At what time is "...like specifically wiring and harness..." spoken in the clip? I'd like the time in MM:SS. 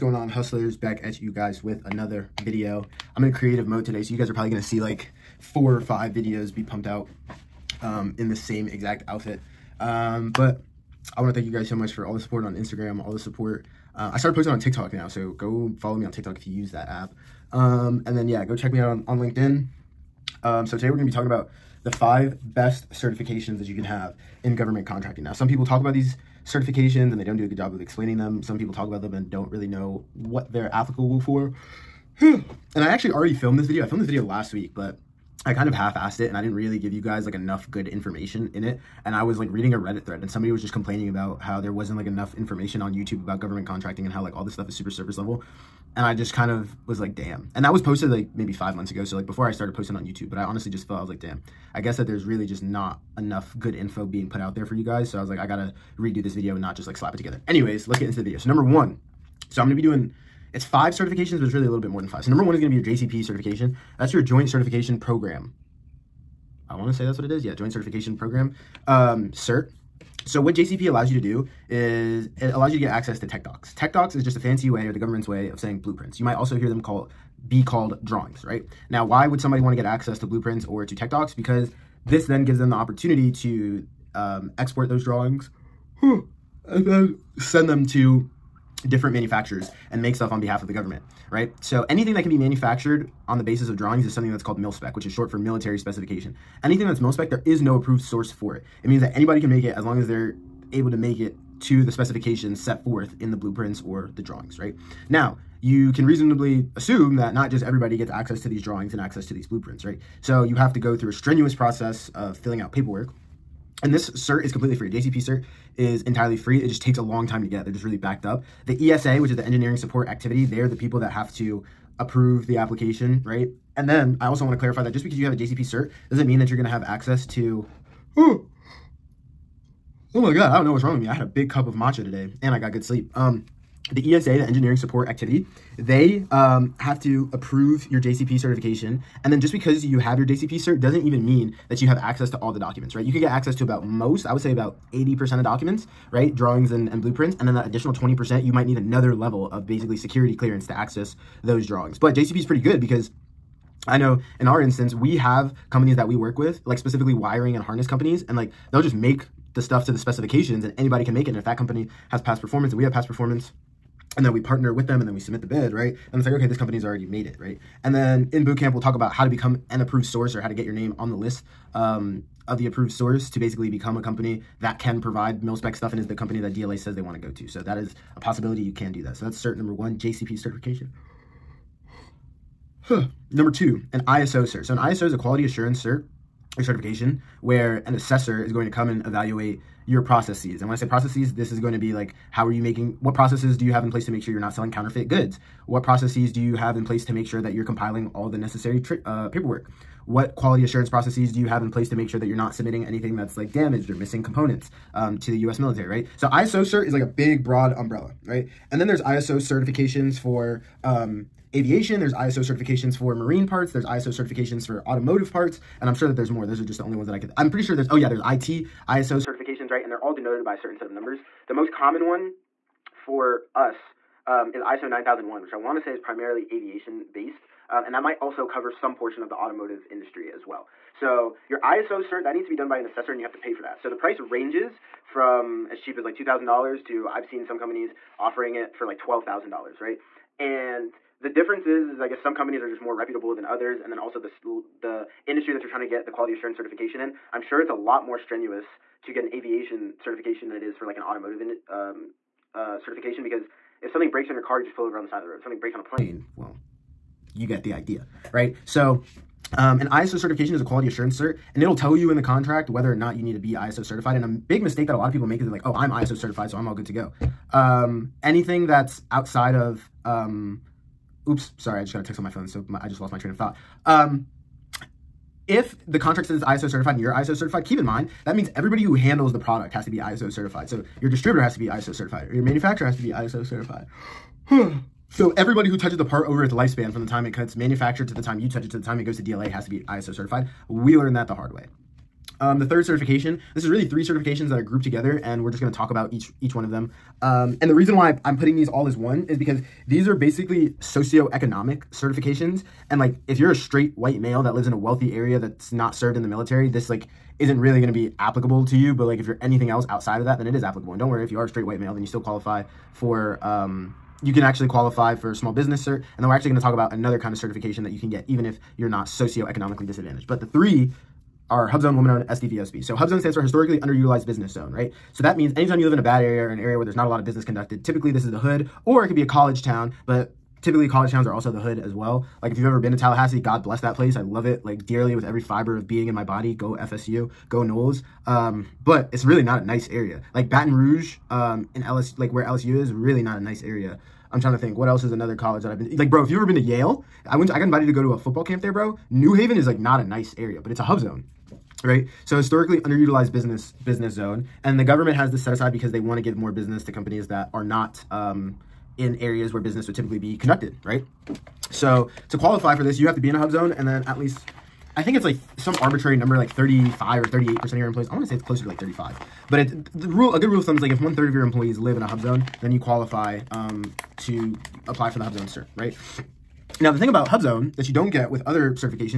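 02:36.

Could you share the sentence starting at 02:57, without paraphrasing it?
So that is a possibility you can do that.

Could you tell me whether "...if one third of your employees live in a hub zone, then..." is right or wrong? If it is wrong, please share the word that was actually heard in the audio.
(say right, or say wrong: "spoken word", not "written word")
right.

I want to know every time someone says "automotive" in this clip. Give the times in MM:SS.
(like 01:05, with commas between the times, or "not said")
03:34, 03:49, 04:11.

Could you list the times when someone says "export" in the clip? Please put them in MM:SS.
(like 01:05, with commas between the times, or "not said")
01:24.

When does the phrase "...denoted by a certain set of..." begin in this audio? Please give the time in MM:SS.
03:40.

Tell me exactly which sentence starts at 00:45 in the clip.
And I just kind of was like, damn.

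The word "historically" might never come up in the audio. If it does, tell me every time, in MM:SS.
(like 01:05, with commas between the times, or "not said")
05:23, 05:52.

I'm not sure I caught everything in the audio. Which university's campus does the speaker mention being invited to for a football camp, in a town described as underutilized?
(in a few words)
Yale.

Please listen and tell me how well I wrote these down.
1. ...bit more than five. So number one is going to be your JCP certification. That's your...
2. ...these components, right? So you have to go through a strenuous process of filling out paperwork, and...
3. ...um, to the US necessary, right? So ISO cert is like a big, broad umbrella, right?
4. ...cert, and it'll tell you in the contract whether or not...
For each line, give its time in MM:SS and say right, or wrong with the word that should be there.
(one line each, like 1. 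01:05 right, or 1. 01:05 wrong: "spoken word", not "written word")
1. 01:01 right
2. 01:49 wrong: "blueprints", not "components"
3. 03:24 wrong: "military", not "necessary"
4. 04:21 right.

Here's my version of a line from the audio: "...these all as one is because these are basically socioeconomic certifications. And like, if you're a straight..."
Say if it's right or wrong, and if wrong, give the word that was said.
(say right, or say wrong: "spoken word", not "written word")
right.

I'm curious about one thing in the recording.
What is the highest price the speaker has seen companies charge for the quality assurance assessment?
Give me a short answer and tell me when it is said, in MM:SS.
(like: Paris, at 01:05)
$12,000, at 03:58.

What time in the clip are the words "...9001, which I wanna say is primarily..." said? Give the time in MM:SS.
03:44.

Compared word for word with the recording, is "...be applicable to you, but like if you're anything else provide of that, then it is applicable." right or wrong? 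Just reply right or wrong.
wrong.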